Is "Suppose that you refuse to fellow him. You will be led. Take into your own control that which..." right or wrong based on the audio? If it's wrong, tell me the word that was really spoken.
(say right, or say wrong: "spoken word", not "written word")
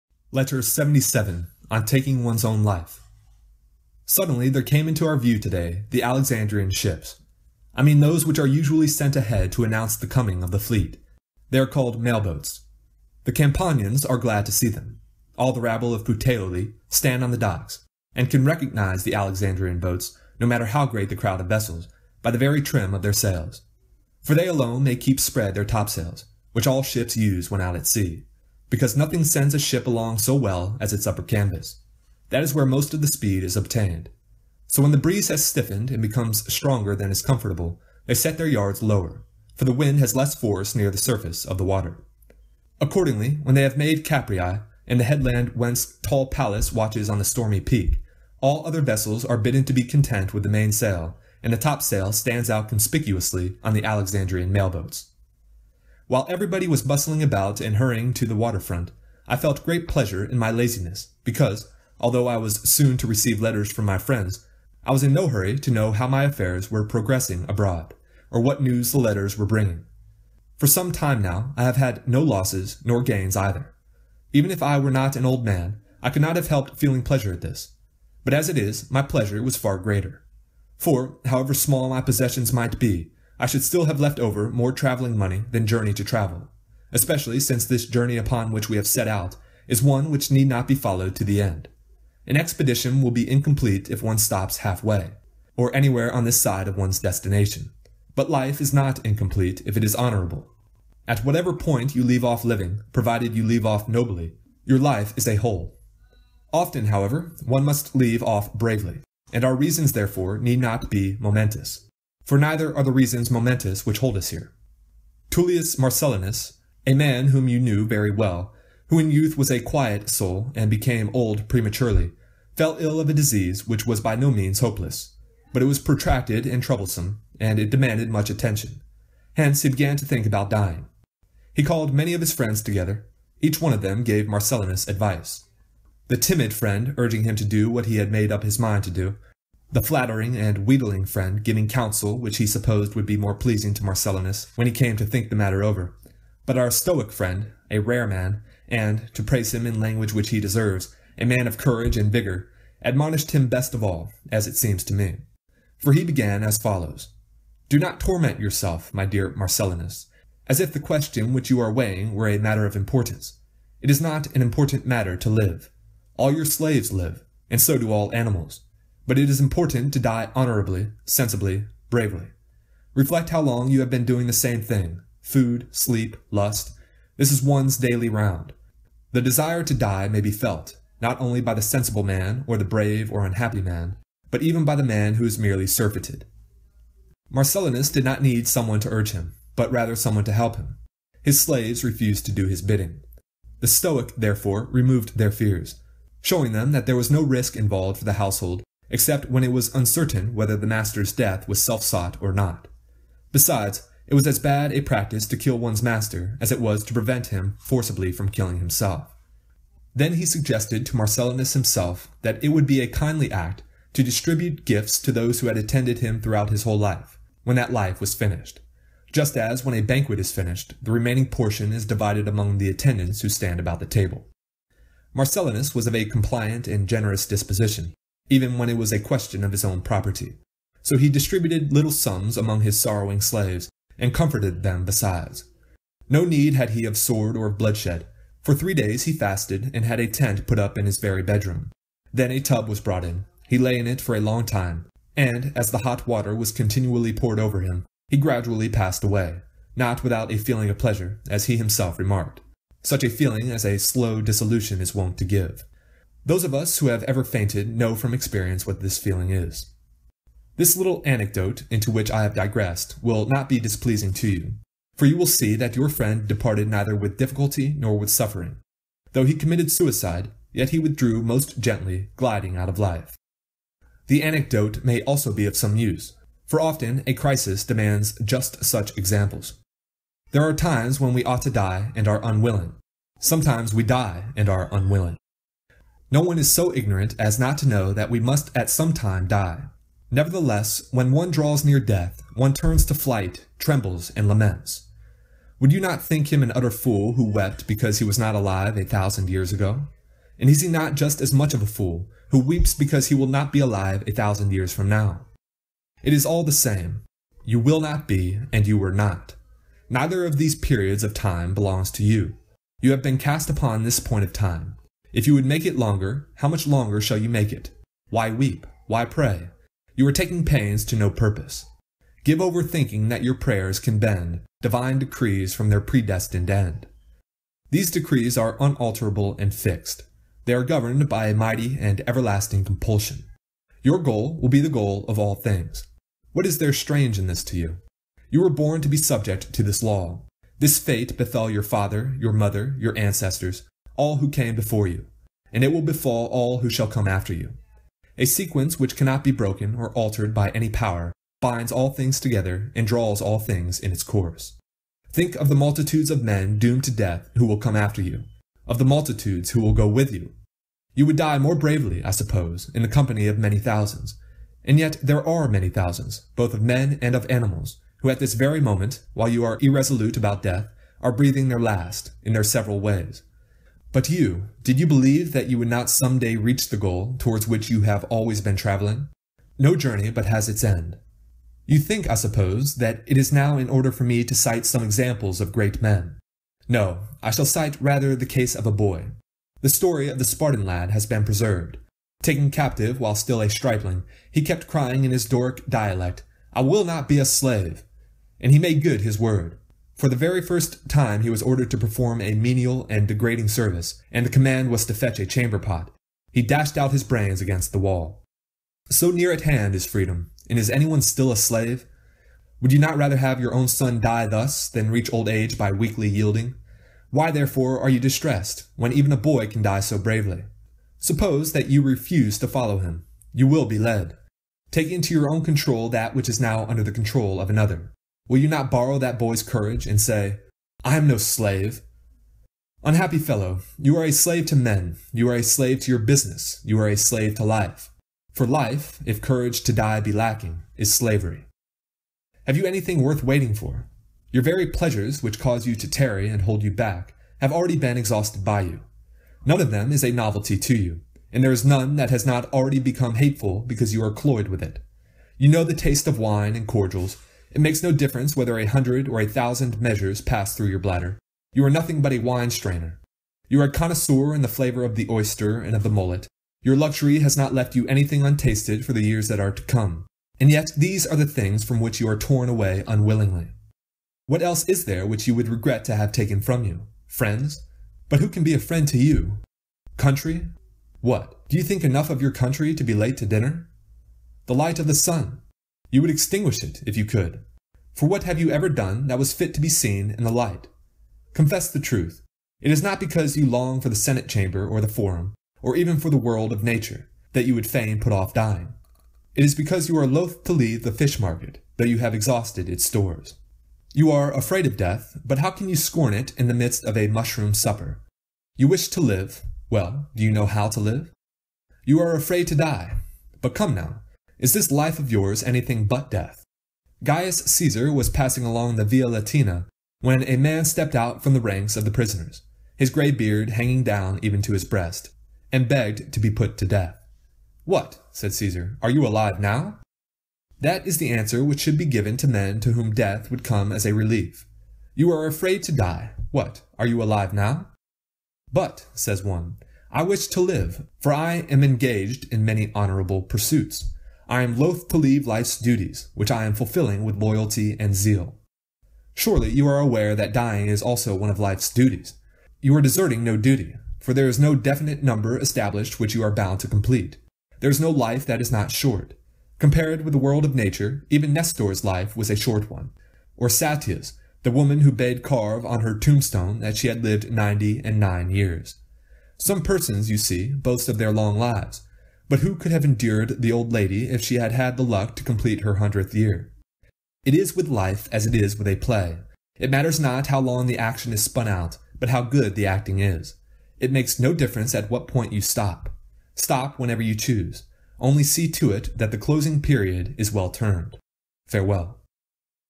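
wrong: "follow", not "fellow".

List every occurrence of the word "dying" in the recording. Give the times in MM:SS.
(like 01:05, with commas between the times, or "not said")
02:10, 08:18, 09:10.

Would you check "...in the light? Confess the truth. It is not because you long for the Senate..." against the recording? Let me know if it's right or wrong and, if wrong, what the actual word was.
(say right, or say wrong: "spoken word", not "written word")
right.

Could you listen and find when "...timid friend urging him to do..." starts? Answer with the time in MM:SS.
02:16.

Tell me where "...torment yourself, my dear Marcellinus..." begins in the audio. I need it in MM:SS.
02:37.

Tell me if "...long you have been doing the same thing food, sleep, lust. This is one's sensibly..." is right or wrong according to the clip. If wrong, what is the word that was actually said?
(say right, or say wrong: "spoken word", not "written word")
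wrong: "daily", not "sensibly".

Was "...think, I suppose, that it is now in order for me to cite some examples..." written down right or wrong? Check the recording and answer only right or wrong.
right.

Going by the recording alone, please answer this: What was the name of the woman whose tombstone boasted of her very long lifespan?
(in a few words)
Sattia.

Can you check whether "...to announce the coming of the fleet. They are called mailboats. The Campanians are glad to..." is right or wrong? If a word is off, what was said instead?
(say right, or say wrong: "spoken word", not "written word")
right.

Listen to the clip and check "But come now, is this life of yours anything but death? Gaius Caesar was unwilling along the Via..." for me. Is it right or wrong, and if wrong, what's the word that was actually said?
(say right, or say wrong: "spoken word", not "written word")
wrong: "passing", not "unwilling".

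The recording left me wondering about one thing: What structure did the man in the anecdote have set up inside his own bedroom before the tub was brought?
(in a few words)
a tent.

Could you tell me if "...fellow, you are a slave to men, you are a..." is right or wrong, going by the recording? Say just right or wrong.
right.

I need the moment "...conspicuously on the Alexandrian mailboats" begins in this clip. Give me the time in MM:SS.
00:52.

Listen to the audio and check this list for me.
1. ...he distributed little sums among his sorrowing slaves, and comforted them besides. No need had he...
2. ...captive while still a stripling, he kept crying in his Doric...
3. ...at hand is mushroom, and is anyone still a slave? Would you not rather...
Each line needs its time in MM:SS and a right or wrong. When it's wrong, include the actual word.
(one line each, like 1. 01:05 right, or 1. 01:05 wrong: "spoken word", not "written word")
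1. 03:50 right
2. 06:32 right
3. 06:49 wrong: "freedom", not "mushroom".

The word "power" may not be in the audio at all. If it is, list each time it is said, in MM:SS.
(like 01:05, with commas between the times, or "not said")
05:50.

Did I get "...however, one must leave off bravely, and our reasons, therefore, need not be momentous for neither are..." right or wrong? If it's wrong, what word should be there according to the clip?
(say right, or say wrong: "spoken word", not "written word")
right.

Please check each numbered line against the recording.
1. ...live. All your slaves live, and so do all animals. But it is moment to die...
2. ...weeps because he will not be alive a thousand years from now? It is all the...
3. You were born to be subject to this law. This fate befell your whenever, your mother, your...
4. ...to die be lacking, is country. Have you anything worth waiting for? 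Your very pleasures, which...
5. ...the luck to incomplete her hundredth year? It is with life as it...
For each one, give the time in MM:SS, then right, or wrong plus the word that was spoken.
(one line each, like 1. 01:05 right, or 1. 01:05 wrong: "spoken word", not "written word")
1. 02:45 wrong: "important", not "moment"
2. 05:02 right
3. 05:38 wrong: "father", not "whenever"
4. 07:19 wrong: "slavery", not "country"
5. 09:34 wrong: "complete", not "incomplete".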